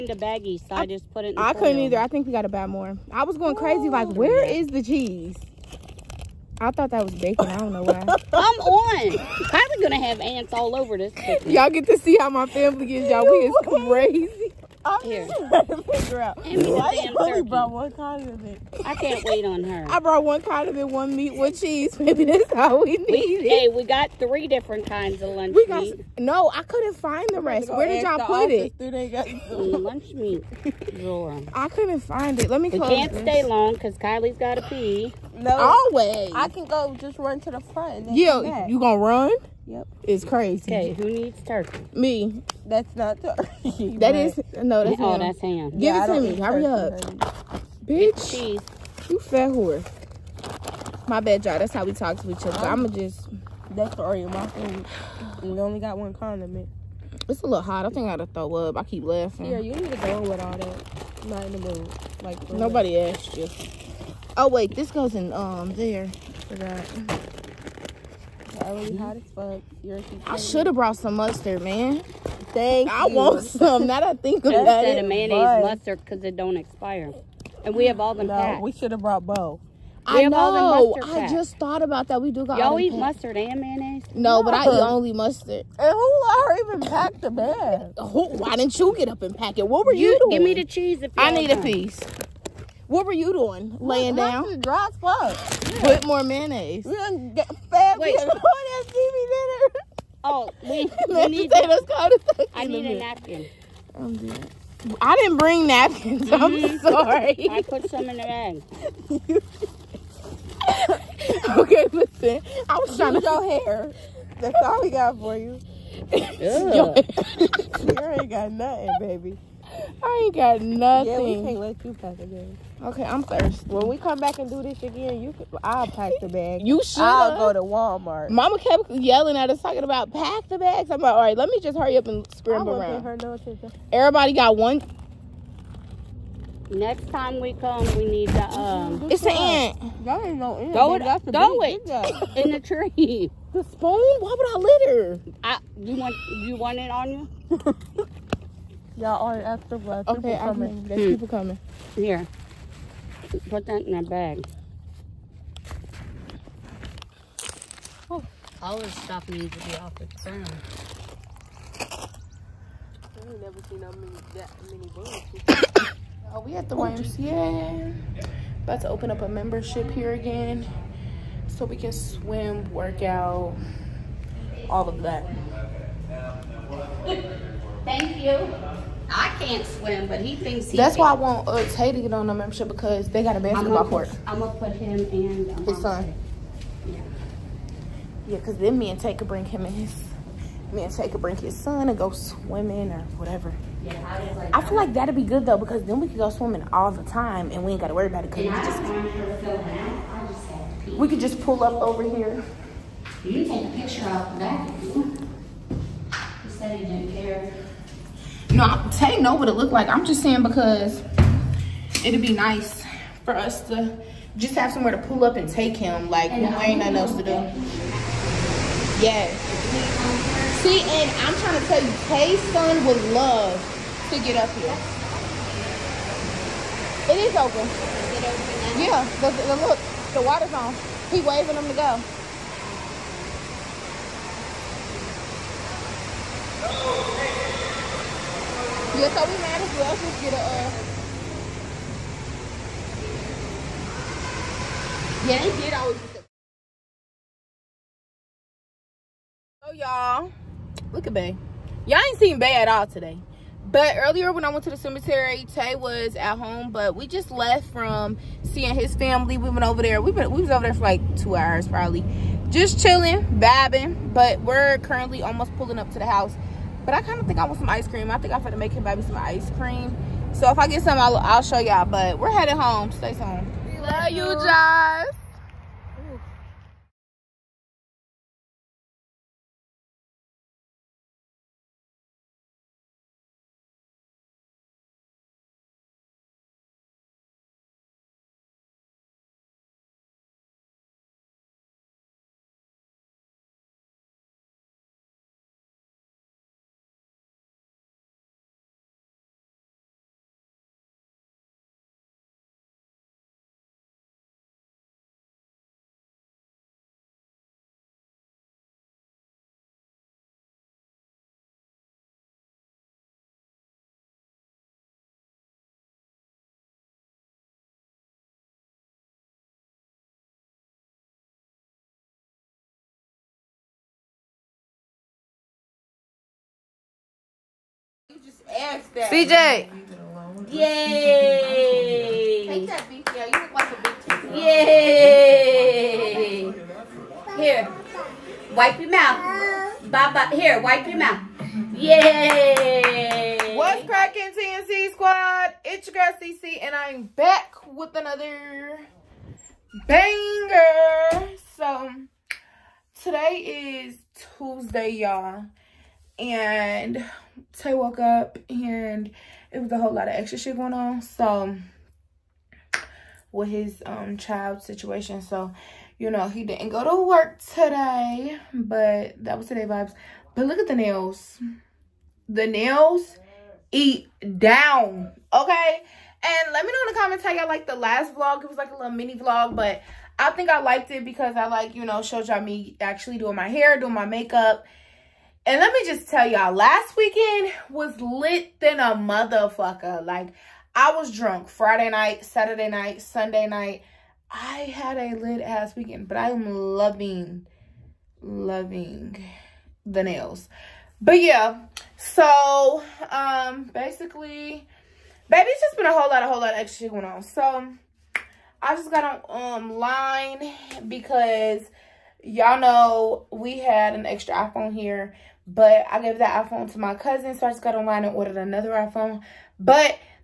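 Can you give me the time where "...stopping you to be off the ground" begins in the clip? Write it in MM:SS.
02:38.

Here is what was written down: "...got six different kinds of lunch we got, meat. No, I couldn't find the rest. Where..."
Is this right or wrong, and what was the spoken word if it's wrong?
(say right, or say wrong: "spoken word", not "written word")
wrong: "three", not "six".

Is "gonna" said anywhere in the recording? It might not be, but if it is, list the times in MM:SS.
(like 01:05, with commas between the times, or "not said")
00:09, 00:38.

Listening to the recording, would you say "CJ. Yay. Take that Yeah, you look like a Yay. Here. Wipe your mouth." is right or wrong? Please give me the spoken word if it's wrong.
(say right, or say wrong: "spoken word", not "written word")
right.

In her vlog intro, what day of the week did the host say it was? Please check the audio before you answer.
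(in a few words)
Tuesday.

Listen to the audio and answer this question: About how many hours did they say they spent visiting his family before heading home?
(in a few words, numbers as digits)
2.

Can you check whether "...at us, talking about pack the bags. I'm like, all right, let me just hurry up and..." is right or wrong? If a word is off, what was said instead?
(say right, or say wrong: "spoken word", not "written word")
right.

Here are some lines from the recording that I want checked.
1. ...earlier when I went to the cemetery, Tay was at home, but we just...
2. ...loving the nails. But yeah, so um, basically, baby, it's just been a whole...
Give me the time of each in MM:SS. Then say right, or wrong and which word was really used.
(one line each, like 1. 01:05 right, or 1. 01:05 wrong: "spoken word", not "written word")
1. 04:13 right
2. 06:38 right.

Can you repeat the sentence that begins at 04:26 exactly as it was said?
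But I kind of think I want some ice cream.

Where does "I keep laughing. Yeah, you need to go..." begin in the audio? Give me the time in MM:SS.
00:58.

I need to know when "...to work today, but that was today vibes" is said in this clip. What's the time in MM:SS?
06:06.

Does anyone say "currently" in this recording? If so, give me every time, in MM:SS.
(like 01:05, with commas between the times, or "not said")
04:24.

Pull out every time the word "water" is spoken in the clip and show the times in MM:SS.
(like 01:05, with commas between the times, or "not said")
03:50.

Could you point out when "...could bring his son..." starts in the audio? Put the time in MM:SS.
03:11.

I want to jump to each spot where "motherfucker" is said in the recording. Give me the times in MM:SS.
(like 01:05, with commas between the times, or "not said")
06:28.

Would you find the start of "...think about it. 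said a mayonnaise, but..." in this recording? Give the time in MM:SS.
01:14.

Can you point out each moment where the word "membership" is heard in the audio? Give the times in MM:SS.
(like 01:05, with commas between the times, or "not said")
02:49, 03:02.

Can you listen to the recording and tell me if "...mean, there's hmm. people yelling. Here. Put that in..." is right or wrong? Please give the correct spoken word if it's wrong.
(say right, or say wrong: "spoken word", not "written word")
wrong: "coming", not "yelling".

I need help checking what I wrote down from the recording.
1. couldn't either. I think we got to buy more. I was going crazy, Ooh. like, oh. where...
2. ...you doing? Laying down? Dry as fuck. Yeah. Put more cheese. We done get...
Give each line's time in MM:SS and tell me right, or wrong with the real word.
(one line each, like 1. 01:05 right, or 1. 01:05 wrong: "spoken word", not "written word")
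1. 00:01 right
2. 01:33 wrong: "mayonnaise", not "cheese".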